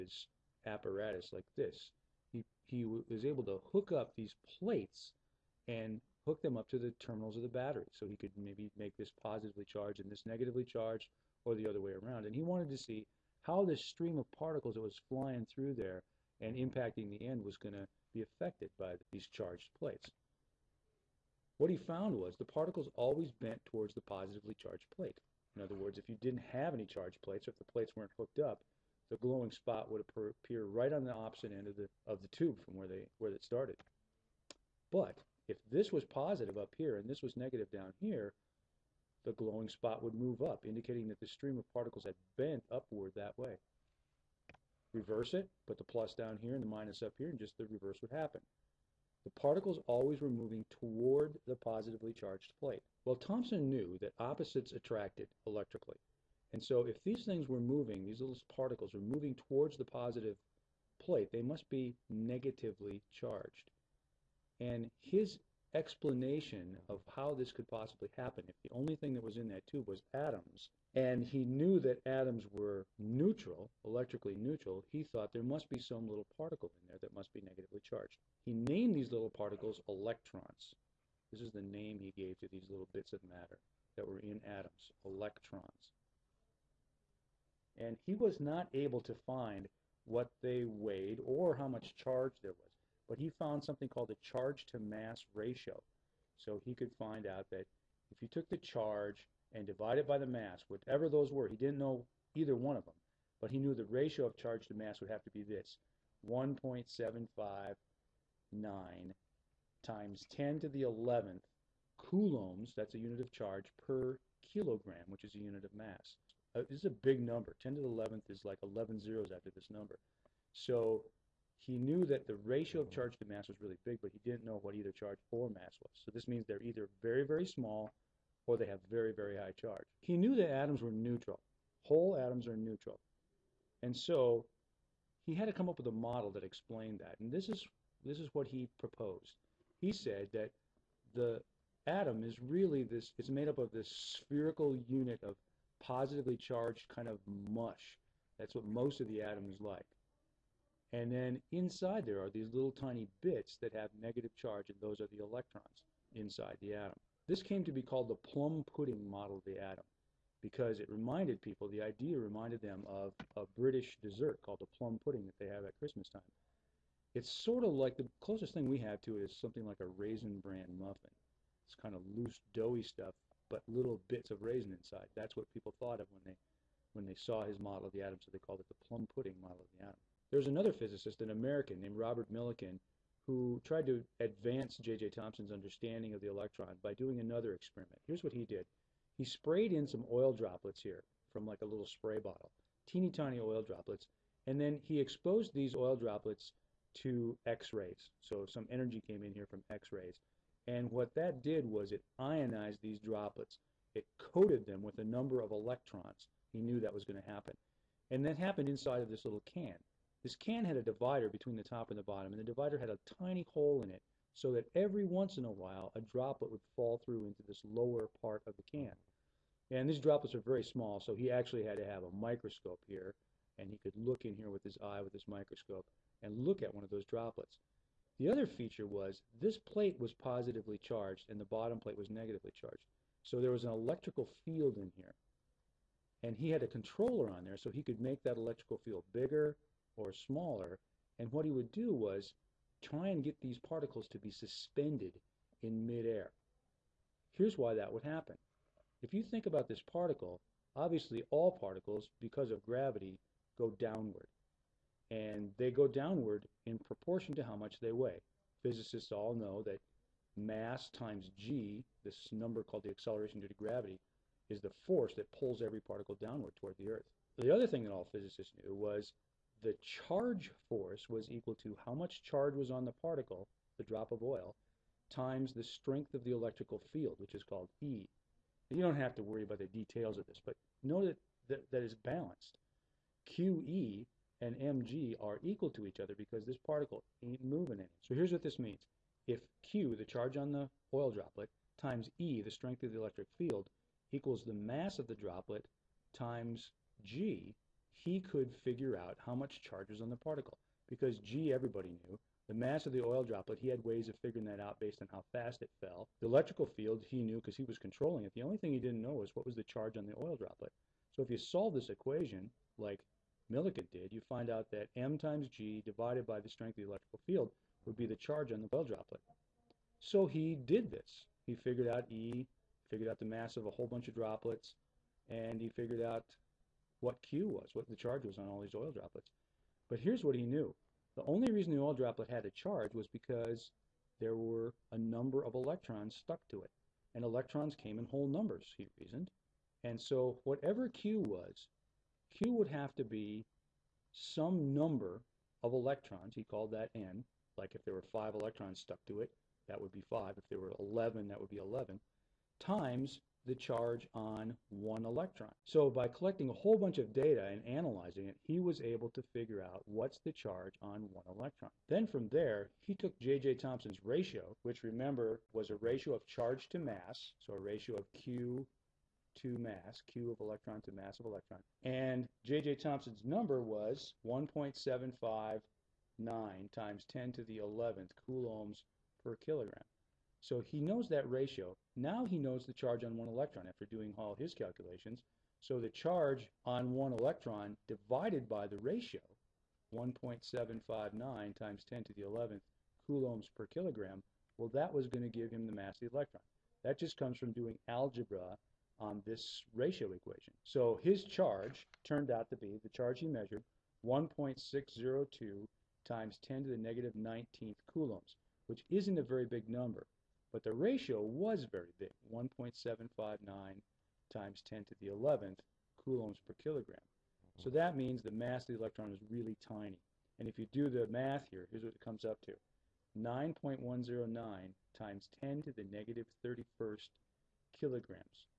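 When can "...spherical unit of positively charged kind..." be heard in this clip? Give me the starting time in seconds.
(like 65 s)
143 s.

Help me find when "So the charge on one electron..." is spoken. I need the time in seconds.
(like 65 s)
385 s.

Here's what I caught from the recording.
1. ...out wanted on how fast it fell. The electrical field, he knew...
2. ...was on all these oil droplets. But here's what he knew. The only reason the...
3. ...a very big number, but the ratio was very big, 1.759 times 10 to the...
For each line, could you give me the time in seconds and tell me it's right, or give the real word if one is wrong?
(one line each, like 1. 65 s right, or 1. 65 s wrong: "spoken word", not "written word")
1. 304 s wrong: "based", not "wanted"
2. 328 s right
3. 409 s right.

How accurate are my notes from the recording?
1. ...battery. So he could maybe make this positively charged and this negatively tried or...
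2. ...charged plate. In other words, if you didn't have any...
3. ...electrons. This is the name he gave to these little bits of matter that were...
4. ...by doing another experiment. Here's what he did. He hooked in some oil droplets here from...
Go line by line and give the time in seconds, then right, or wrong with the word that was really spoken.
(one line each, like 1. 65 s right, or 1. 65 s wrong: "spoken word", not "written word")
1. 7 s wrong: "charged", not "tried"
2. 24 s right
3. 79 s right
4. 186 s wrong: "sprayed", not "hooked".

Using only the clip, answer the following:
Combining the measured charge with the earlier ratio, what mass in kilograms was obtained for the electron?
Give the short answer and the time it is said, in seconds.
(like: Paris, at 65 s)
9.109 x 10^-31, at 423 s.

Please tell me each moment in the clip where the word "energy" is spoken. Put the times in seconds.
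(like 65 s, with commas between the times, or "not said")
198 s.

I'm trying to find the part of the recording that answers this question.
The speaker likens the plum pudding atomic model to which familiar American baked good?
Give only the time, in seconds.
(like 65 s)
169 s.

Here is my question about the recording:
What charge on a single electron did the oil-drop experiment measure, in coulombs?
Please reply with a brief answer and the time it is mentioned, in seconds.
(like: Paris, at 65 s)
1.602 x 10^-19, at 404 s.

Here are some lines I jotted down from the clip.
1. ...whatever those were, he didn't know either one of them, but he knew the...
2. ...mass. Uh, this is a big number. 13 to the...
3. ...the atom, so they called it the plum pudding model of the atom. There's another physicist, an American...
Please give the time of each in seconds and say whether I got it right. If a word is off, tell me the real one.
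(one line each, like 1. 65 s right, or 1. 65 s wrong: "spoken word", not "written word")
1. 100 s right
2. 115 s wrong: "10", not "13"
3. 177 s right.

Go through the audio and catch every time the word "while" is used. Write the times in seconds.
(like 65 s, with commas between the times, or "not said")
215 s.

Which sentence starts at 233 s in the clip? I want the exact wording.
So there was an electrical field in here.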